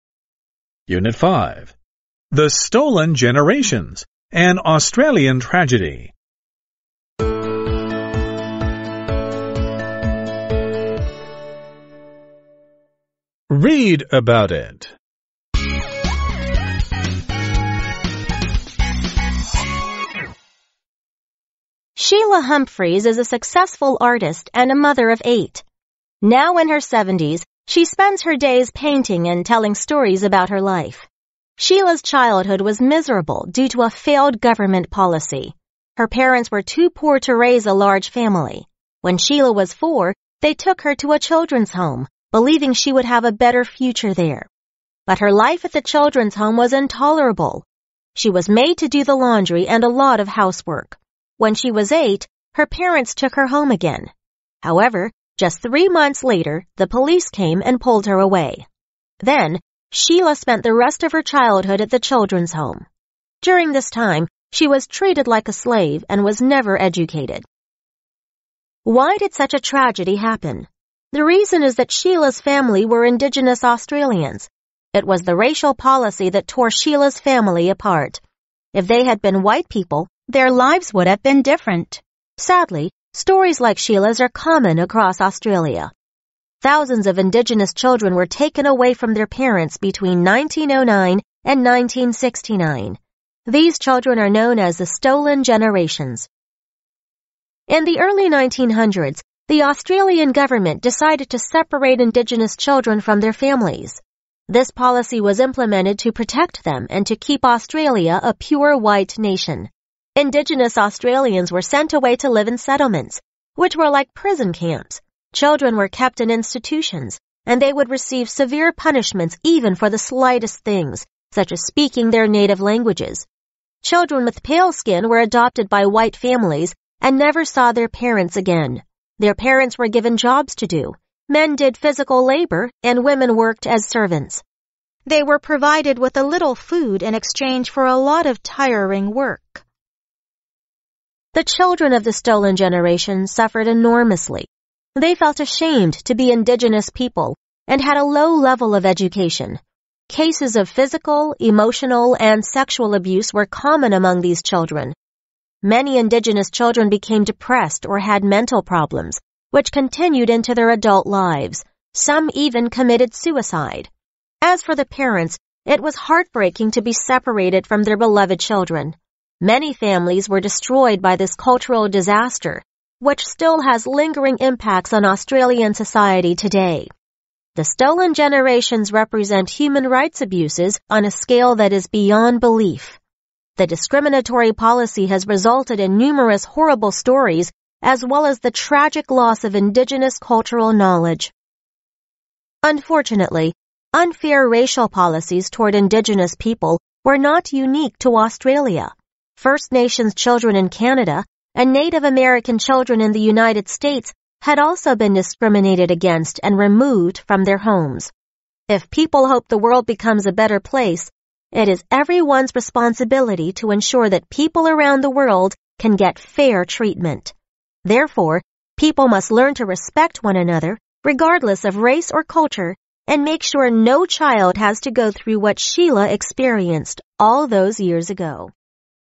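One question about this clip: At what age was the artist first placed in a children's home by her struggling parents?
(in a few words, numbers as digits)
4.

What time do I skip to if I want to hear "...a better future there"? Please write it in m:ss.
0:43.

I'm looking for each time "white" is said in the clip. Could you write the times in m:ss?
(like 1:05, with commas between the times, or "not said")
1:19, 1:48, 2:05.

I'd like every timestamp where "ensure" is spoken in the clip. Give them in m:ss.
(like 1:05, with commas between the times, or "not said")
3:33.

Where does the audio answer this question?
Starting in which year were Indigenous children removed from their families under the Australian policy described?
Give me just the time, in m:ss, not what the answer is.
1:30.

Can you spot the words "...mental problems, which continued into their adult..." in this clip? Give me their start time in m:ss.
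2:38.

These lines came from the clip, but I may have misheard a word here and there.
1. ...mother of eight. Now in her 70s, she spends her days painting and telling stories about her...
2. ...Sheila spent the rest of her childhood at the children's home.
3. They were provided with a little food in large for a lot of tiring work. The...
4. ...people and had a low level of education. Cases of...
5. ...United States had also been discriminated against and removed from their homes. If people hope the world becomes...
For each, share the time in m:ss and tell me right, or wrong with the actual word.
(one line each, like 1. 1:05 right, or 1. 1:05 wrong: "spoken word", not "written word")
1. 0:24 right
2. 0:59 right
3. 2:15 wrong: "exchange", not "large"
4. 2:26 right
5. 3:23 right.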